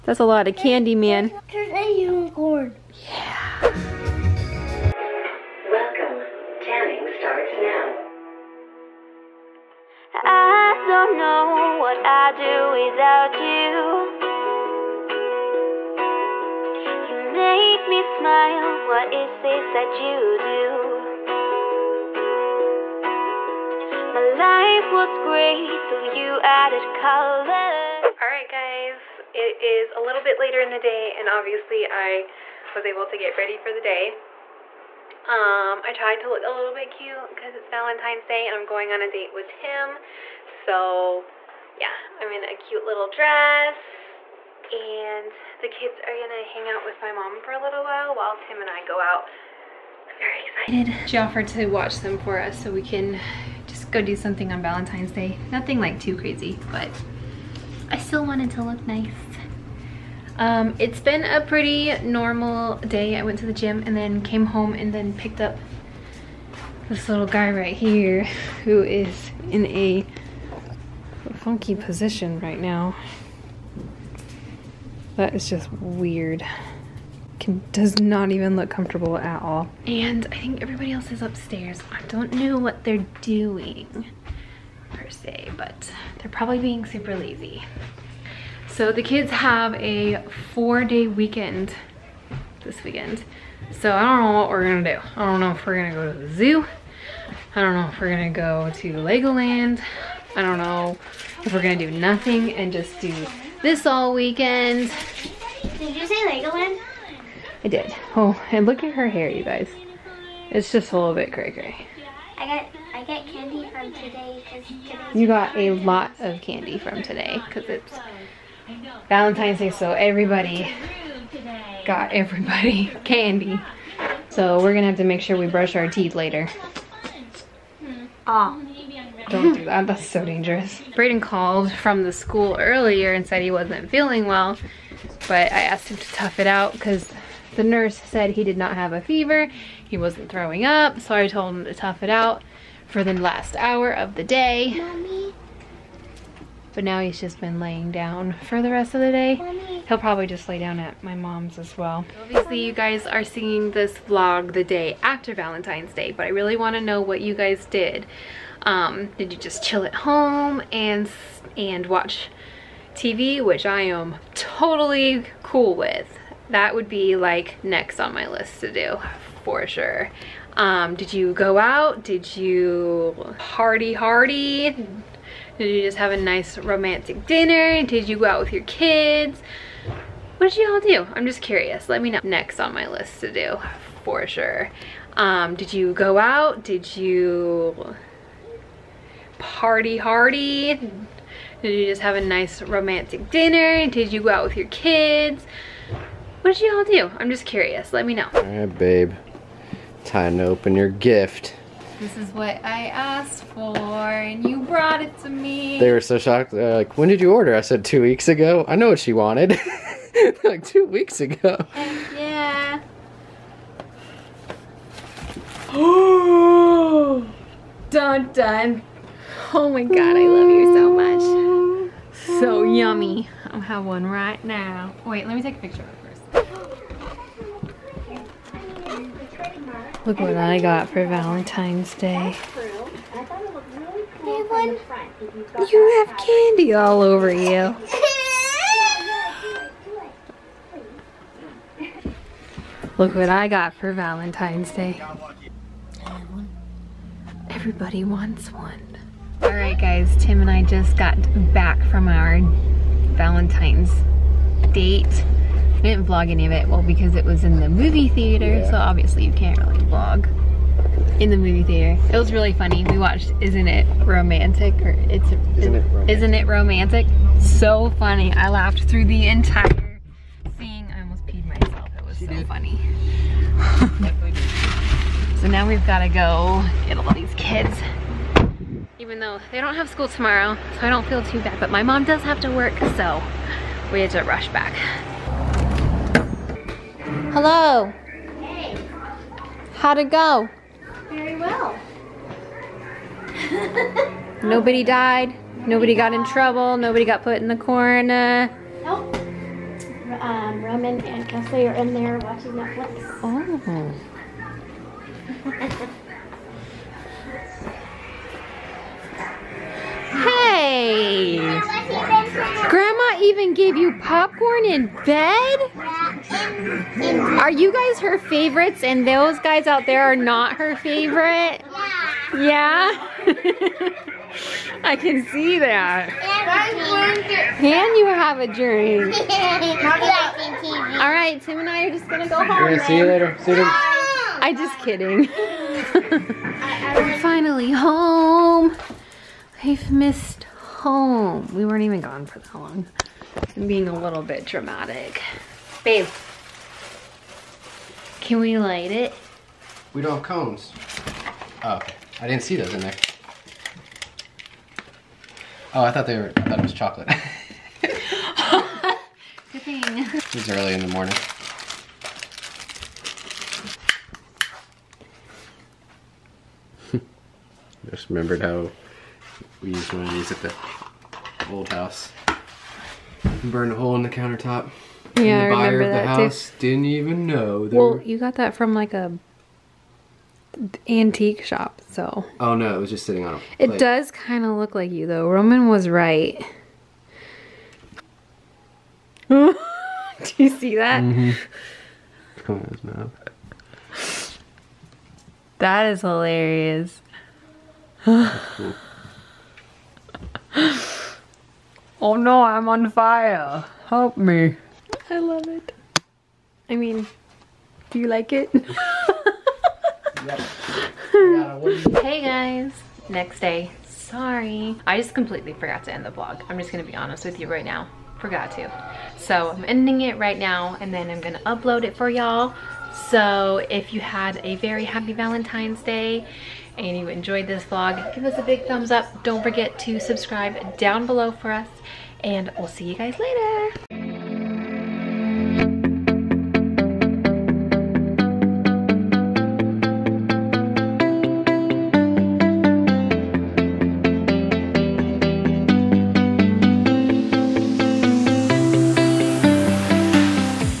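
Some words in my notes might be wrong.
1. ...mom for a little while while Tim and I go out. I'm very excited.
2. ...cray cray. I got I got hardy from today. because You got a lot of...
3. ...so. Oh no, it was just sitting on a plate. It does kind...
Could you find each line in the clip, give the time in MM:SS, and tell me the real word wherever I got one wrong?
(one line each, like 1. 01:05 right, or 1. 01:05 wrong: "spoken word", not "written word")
1. 00:47 right
2. 01:51 wrong: "candy", not "hardy"
3. 06:21 right.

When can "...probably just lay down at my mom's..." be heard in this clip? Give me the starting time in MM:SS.
02:29.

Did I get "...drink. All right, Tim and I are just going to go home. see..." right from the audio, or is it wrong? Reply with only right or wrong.
right.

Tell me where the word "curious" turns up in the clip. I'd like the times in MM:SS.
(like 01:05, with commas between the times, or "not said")
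03:01, 03:17.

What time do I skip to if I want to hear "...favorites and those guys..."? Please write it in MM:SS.
05:18.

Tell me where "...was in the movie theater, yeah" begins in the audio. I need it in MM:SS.
04:17.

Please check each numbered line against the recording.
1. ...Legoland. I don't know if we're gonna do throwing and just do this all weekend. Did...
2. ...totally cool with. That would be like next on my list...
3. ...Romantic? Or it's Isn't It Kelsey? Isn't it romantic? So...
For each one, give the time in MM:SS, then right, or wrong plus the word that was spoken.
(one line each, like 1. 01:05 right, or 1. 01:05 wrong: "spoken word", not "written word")
1. 01:38 wrong: "nothing", not "throwing"
2. 02:44 right
3. 04:24 wrong: "Romantic", not "Kelsey".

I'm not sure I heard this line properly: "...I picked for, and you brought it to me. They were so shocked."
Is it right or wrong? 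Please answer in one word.
wrong.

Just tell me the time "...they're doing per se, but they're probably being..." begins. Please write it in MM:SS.
01:22.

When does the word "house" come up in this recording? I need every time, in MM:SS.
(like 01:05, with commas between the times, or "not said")
06:11, 06:16.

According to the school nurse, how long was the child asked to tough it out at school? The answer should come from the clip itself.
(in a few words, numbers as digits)
The last hour.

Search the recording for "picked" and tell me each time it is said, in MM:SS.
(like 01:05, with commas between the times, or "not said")
01:05.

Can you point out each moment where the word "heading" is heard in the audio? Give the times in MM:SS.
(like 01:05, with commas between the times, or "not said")
not said.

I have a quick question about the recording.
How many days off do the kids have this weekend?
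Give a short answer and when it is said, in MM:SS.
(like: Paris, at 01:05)
4, at 01:30.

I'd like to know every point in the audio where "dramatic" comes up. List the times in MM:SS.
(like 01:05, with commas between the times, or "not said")
05:44.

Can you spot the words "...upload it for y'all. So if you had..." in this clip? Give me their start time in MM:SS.
07:01.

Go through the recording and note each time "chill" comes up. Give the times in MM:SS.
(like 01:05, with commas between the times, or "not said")
02:39.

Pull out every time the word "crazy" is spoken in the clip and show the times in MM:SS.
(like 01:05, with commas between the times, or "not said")
00:56.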